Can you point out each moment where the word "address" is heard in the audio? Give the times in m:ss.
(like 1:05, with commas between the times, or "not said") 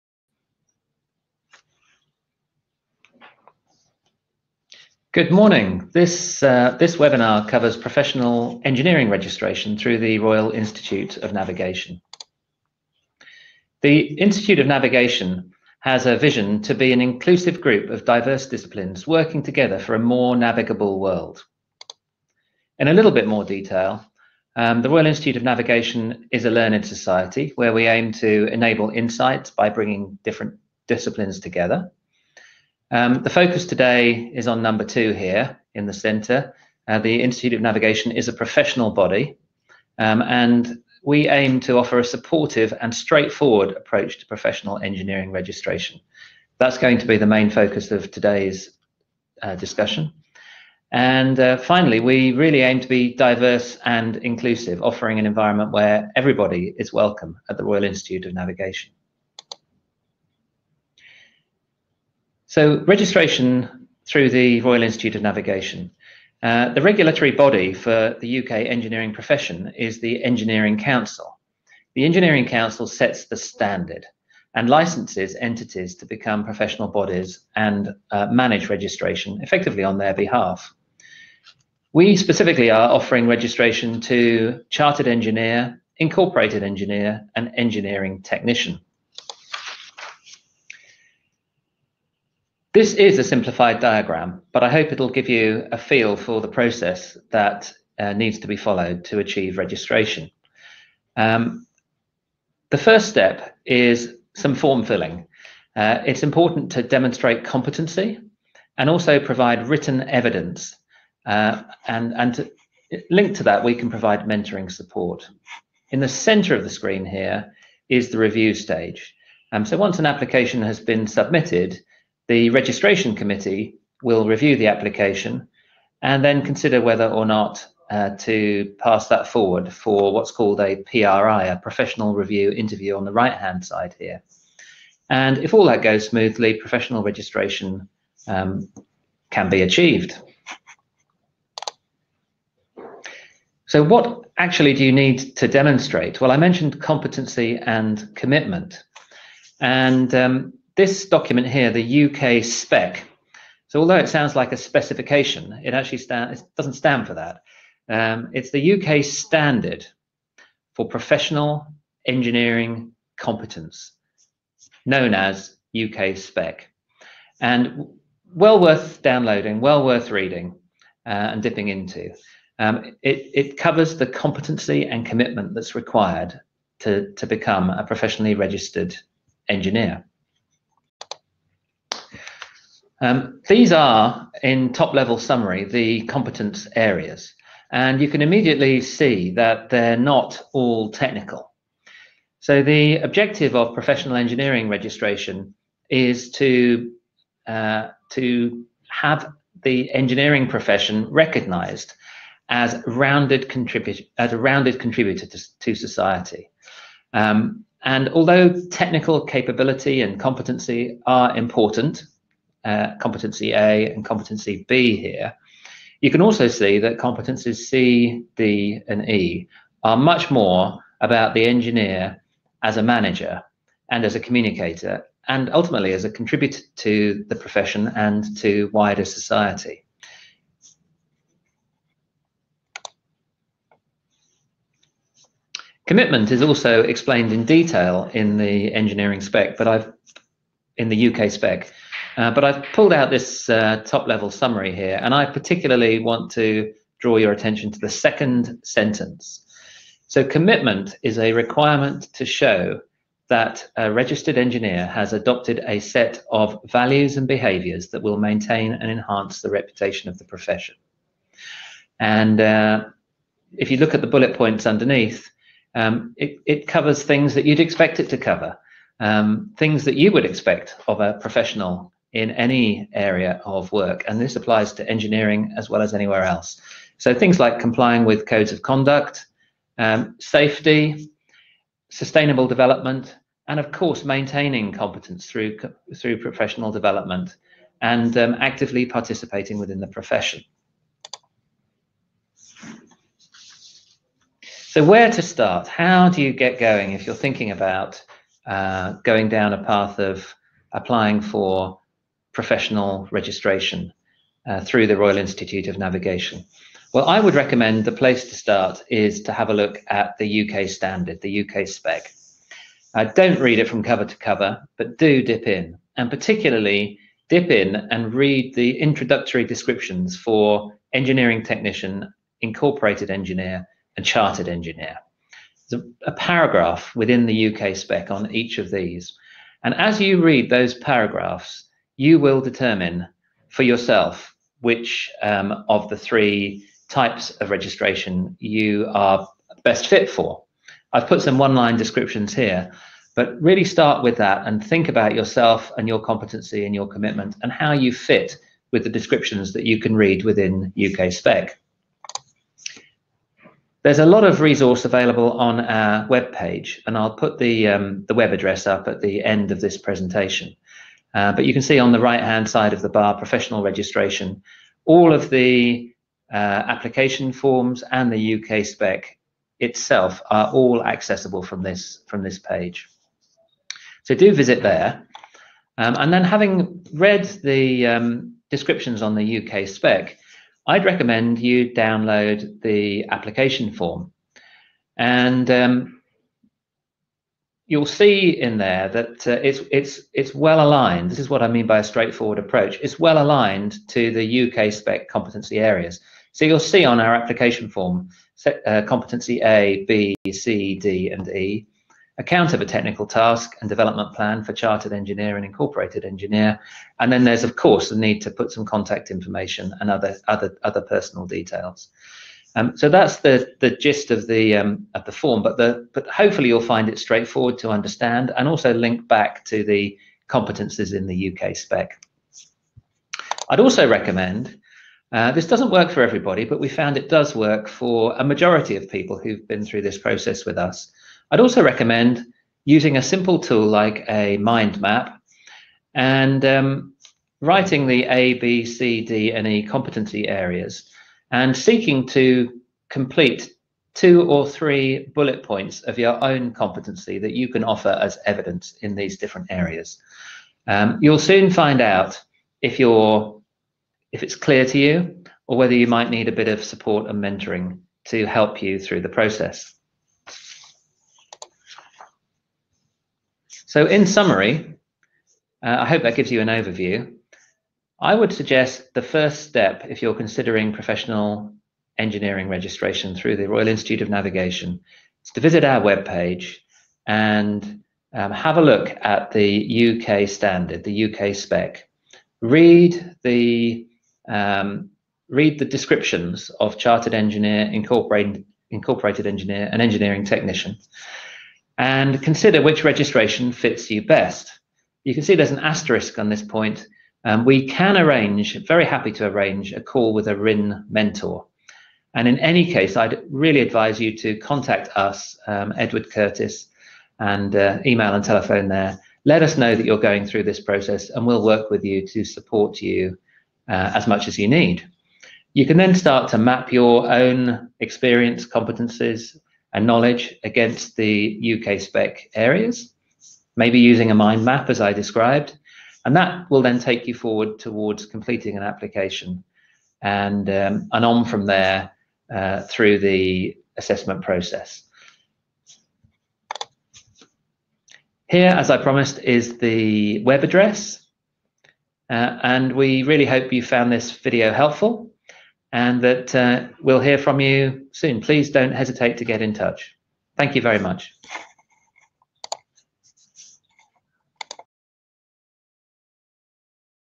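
5:58, 9:00.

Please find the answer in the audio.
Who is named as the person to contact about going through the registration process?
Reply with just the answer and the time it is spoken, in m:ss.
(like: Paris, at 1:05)
Edward Curtis, at 8:25.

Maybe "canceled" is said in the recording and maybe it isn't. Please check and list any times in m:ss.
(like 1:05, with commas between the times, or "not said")
not said.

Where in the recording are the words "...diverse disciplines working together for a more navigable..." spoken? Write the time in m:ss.
0:18.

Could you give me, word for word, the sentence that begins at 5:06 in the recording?
Well, I would recommend the place to start is to have a look at the UK standard, the UK spec.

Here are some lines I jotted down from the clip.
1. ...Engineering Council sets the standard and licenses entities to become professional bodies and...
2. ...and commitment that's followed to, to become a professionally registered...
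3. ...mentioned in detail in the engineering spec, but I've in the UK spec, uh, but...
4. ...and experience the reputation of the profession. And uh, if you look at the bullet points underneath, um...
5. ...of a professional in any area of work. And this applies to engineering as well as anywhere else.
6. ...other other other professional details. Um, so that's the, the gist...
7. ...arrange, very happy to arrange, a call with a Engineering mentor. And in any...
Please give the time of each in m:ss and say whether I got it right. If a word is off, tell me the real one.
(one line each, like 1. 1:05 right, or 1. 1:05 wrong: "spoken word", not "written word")
1. 1:12 right
2. 2:54 wrong: "required", not "followed"
3. 3:56 wrong: "explained", not "mentioned"
4. 4:18 wrong: "enhance", not "experience"
5. 4:30 right
6. 6:49 wrong: "personal", not "professional"
7. 8:17 wrong: "RIN", not "Engineering".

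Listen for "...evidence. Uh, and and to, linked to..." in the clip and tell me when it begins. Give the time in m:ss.
1:50.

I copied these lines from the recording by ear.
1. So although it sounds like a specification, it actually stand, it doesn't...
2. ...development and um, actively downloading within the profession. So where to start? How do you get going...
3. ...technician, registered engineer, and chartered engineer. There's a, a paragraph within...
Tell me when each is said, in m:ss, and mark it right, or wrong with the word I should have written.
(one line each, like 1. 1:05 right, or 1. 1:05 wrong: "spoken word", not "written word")
1. 2:33 right
2. 4:46 wrong: "participating", not "downloading"
3. 5:21 wrong: "incorporated", not "registered".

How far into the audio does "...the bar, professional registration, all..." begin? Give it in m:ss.
6:02.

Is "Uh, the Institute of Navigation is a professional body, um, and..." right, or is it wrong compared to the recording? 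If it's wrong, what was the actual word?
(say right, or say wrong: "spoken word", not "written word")
right.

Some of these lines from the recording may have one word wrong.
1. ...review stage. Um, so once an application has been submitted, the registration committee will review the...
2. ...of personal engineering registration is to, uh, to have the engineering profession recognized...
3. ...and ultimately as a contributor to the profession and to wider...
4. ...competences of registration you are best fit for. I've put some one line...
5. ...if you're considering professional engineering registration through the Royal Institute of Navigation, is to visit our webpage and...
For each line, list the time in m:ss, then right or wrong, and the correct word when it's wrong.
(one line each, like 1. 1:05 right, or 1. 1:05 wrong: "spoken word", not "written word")
1. 1:58 right
2. 3:13 wrong: "professional", not "personal"
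3. 3:45 right
4. 5:36 wrong: "types", not "competences"
5. 7:49 right.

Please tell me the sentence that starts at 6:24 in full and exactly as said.
And um, you'll see in there that uh, it's it's it's well aligned.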